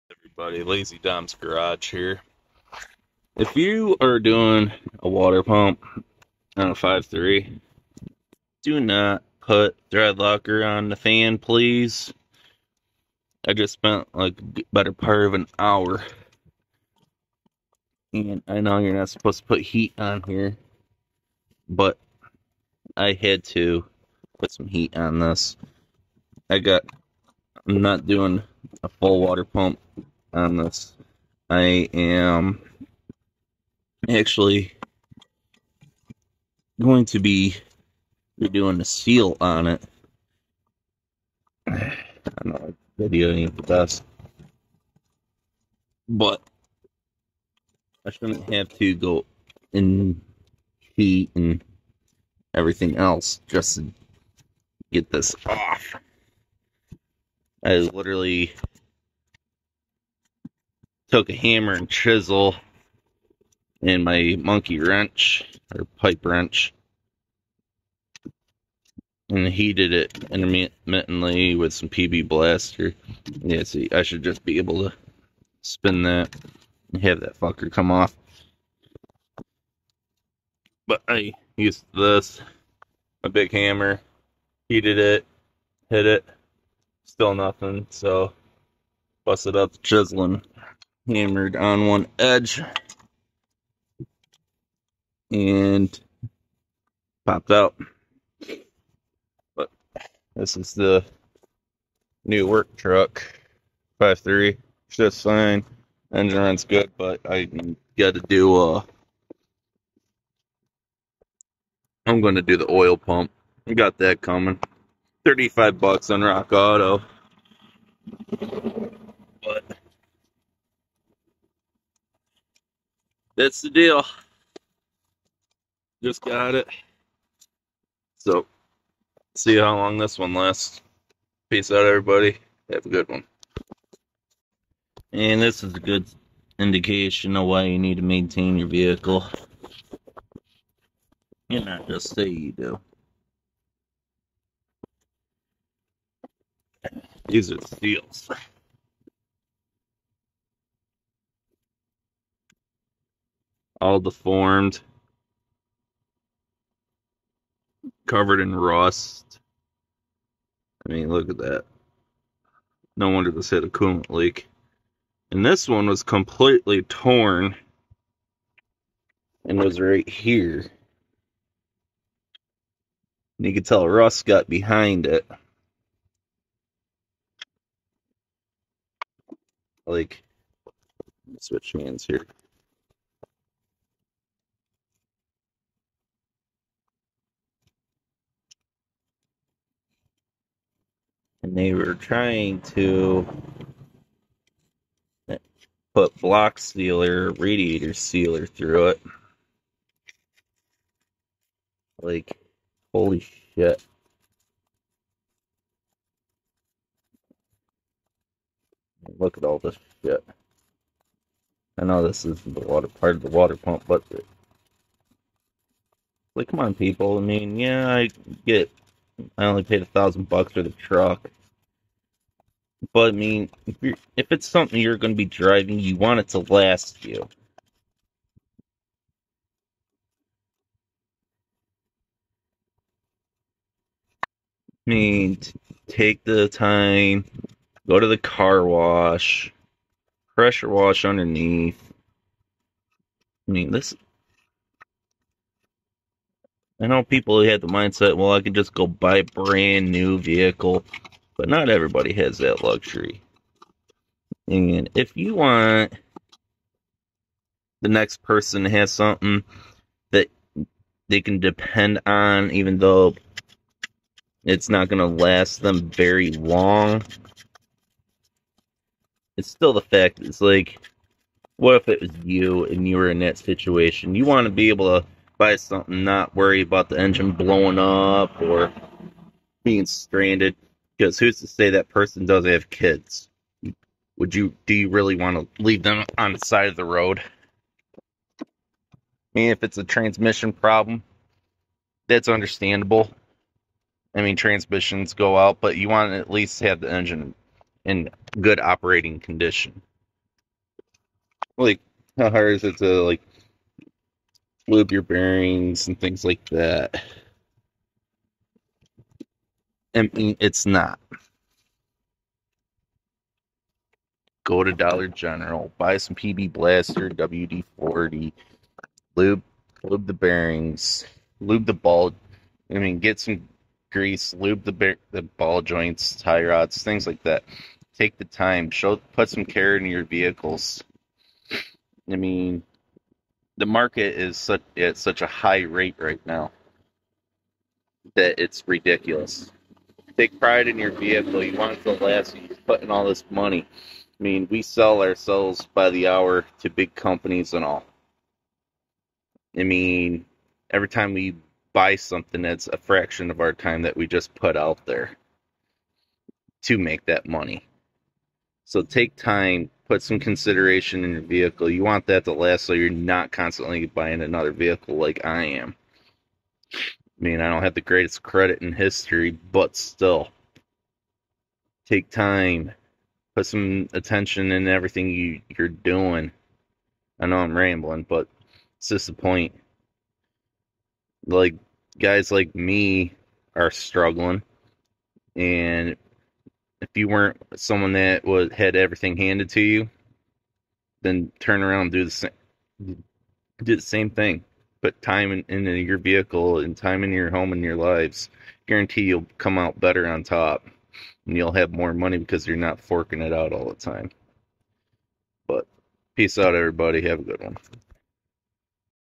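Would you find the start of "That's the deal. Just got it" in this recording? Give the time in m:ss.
2:03.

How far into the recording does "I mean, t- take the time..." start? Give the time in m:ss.
3:54.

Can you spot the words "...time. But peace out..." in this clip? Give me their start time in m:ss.
6:43.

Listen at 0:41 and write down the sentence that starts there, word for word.
I know video videoing the best, but I shouldn't have to go in heat and everything else just to get this off.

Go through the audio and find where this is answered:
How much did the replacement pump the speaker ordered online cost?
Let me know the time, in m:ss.
1:55.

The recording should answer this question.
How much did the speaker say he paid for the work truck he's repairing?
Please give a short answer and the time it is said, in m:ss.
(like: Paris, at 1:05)
$1,000, at 3:39.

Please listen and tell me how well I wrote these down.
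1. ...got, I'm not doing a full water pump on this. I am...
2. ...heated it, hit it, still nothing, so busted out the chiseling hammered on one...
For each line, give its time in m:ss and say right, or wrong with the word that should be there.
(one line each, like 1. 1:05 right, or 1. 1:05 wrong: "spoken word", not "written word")
1. 0:26 right
2. 1:24 right.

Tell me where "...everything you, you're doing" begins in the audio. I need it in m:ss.
6:14.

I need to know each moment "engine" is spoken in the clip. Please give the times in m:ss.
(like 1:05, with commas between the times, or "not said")
1:46, 4:36, 4:56.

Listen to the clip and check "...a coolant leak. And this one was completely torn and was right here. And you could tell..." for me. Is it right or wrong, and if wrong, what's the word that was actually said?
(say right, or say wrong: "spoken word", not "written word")
right.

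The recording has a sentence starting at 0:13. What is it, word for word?
I just spent like better part of an hour.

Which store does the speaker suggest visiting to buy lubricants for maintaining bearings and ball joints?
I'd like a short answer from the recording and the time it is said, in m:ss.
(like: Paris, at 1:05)
Dollar General, at 5:14.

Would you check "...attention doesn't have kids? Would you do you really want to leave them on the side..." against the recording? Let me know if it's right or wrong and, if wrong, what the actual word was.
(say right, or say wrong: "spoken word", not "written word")
wrong: "person", not "attention".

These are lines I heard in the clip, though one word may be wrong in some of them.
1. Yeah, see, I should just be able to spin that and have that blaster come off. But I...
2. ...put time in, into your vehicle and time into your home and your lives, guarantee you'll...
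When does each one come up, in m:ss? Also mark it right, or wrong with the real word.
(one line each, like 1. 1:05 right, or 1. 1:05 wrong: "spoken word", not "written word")
1. 1:13 wrong: "fucker", not "blaster"
2. 6:34 right.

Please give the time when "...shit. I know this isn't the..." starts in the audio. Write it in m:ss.
3:30.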